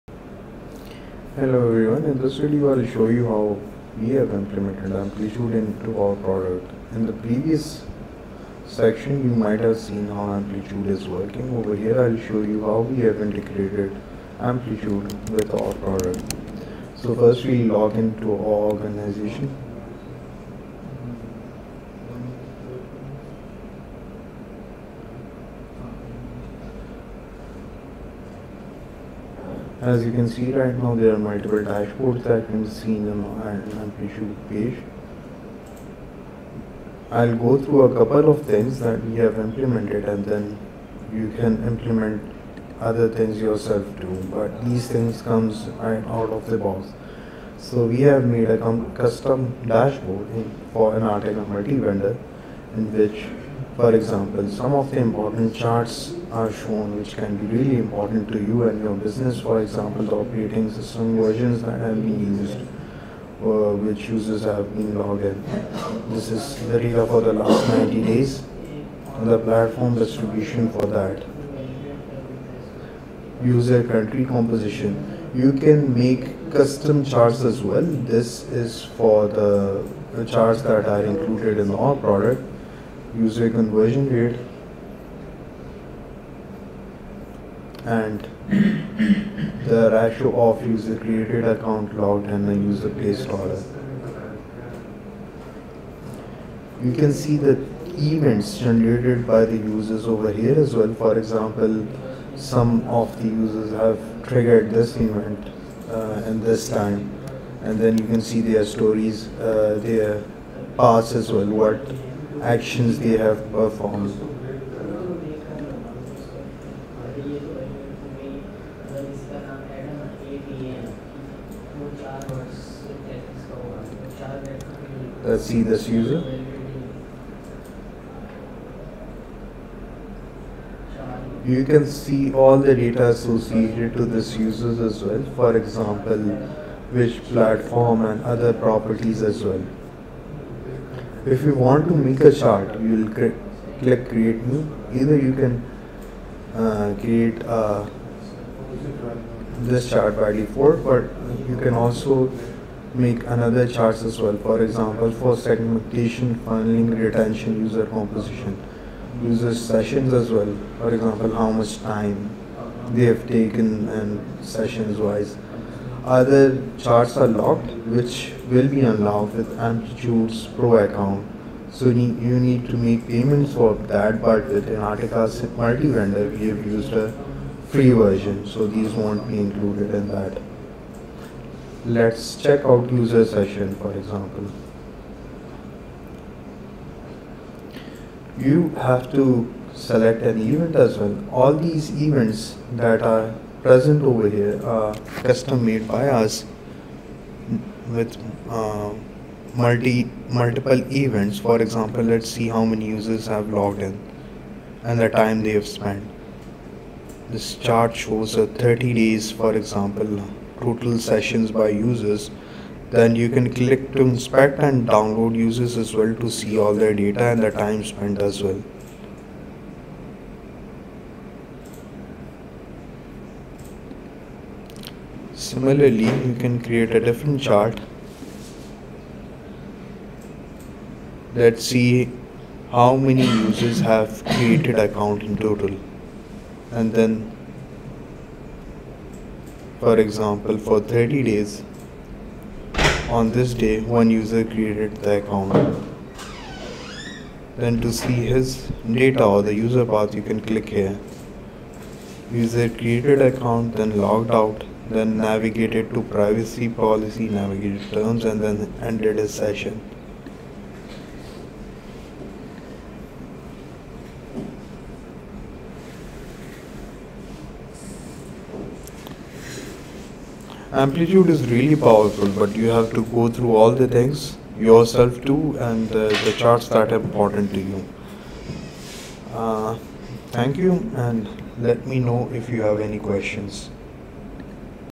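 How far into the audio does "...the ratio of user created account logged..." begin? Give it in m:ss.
1:29.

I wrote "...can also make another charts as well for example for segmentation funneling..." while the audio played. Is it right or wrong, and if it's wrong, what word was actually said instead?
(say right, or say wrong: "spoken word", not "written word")
right.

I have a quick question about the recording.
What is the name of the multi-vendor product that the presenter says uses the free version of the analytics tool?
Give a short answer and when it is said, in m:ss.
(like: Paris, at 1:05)
Enatega, at 2:54.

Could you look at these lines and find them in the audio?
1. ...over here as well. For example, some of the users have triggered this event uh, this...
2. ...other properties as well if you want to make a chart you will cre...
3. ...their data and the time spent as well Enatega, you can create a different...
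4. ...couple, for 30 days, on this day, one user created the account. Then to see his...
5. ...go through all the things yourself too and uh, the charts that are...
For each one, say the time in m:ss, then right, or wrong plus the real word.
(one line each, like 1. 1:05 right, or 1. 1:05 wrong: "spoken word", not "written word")
1. 1:40 right
2. 2:18 right
3. 3:36 wrong: "Similarly", not "Enatega"
4. 3:59 wrong: "example", not "couple"
5. 4:33 right.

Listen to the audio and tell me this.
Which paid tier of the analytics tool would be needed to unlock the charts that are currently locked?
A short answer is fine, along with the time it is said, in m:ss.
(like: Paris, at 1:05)
Pro account, at 2:50.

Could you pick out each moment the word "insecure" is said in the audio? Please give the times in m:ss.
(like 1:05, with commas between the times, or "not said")
not said.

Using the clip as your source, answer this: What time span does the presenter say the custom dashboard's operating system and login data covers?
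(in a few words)
last 90 days.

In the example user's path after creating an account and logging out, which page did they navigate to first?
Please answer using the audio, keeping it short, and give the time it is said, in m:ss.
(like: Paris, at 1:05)
privacy policy, at 4:16.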